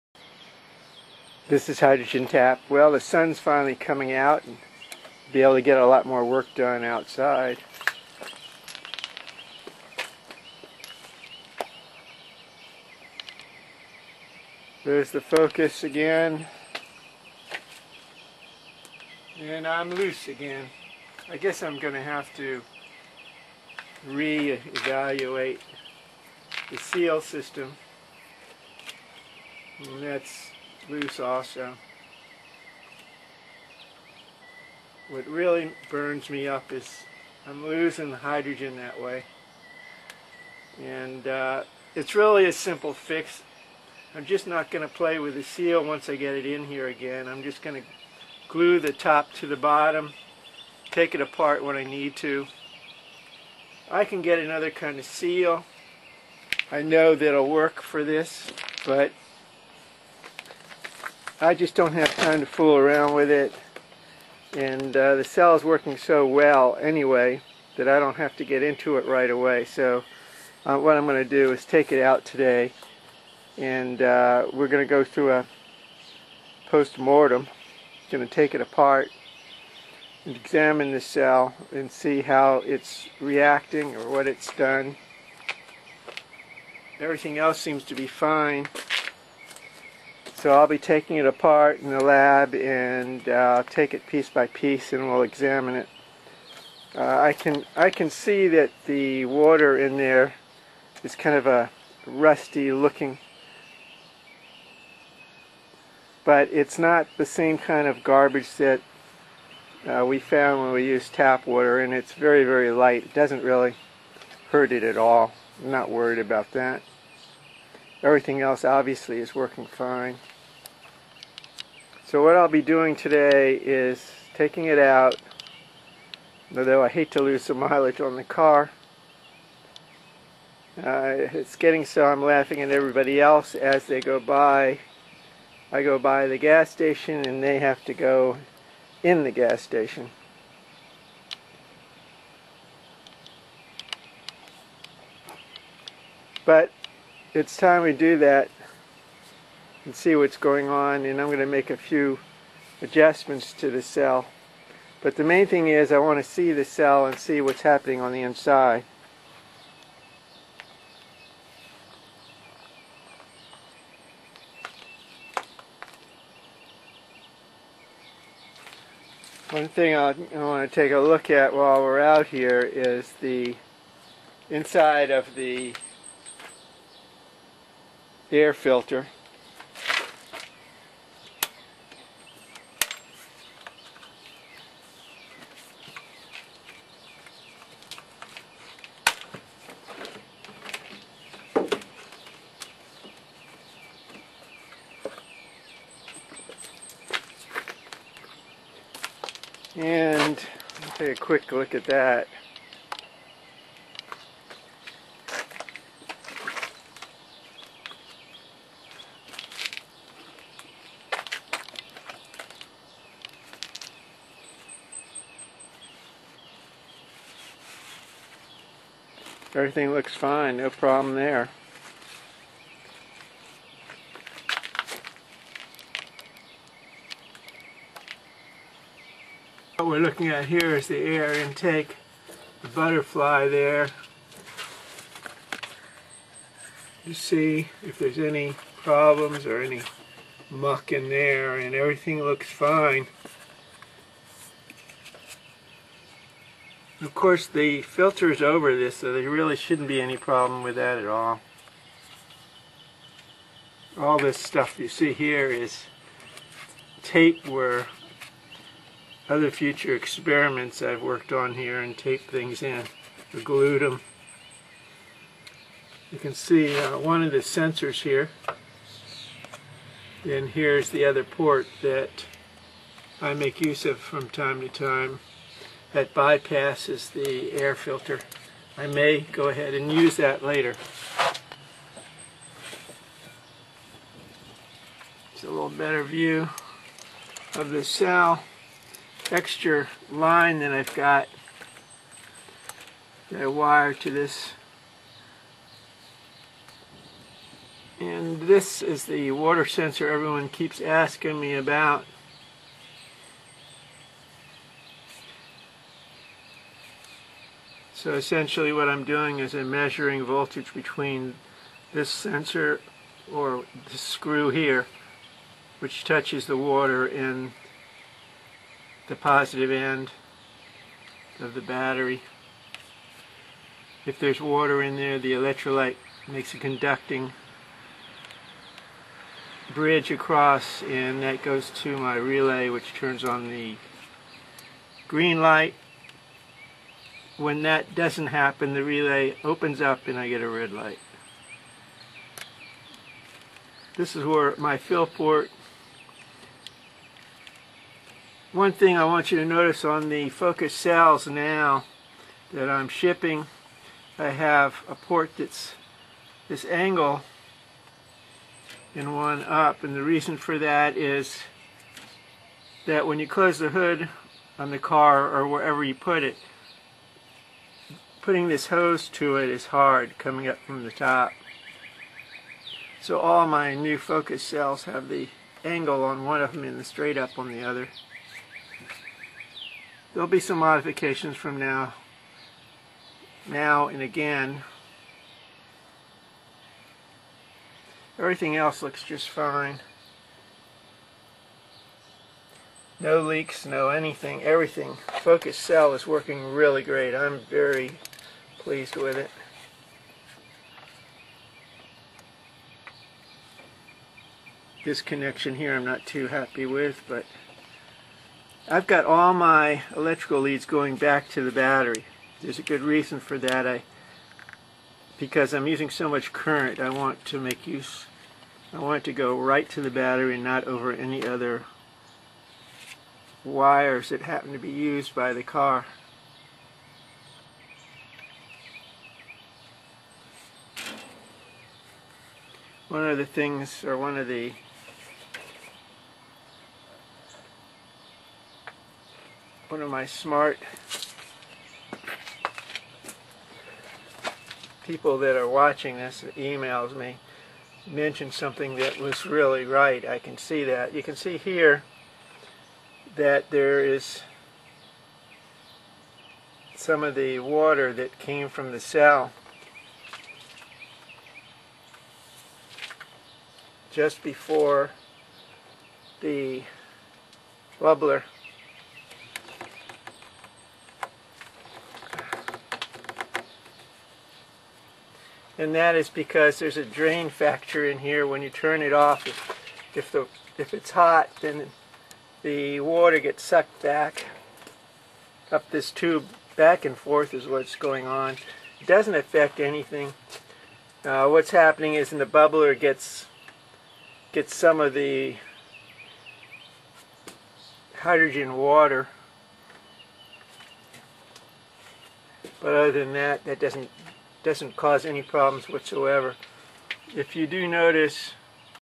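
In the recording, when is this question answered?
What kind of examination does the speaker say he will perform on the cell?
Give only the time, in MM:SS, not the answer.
01:16.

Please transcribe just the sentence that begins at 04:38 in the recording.
I may go ahead and use that later.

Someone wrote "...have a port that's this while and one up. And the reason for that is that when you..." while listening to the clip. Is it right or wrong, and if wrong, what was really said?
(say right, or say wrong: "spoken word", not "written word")
wrong: "angle", not "while".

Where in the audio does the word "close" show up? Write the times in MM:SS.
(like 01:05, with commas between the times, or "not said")
06:03.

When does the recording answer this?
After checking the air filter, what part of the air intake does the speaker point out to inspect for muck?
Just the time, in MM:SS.
03:52.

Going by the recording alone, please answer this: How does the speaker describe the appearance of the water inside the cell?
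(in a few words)
rusty looking.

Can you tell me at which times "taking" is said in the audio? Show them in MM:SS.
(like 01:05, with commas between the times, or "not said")
01:30, 02:04.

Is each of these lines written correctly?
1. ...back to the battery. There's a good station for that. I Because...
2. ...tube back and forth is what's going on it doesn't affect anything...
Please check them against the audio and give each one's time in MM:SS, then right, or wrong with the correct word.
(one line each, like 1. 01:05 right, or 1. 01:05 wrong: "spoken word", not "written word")
1. 06:50 wrong: "reason", not "station"
2. 08:05 right.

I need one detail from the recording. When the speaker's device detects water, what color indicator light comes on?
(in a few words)
green.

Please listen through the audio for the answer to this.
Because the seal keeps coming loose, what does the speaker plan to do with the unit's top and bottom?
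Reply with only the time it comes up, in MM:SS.
00:48.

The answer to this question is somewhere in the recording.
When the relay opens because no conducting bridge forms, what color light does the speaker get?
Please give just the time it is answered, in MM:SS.
05:40.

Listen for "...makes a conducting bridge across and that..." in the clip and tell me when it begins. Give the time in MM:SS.
05:26.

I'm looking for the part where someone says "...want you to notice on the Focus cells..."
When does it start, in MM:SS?
05:49.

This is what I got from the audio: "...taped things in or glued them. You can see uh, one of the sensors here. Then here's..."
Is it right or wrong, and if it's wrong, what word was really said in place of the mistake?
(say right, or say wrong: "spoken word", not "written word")
right.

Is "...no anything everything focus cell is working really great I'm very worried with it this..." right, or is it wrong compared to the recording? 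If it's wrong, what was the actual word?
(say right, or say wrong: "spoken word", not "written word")
wrong: "pleased", not "worried".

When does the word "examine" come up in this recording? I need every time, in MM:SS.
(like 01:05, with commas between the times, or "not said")
01:20, 01:35.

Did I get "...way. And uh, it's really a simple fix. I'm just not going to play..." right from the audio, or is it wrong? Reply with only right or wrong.
right.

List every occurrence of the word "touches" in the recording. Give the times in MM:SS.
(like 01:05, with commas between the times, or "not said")
05:16.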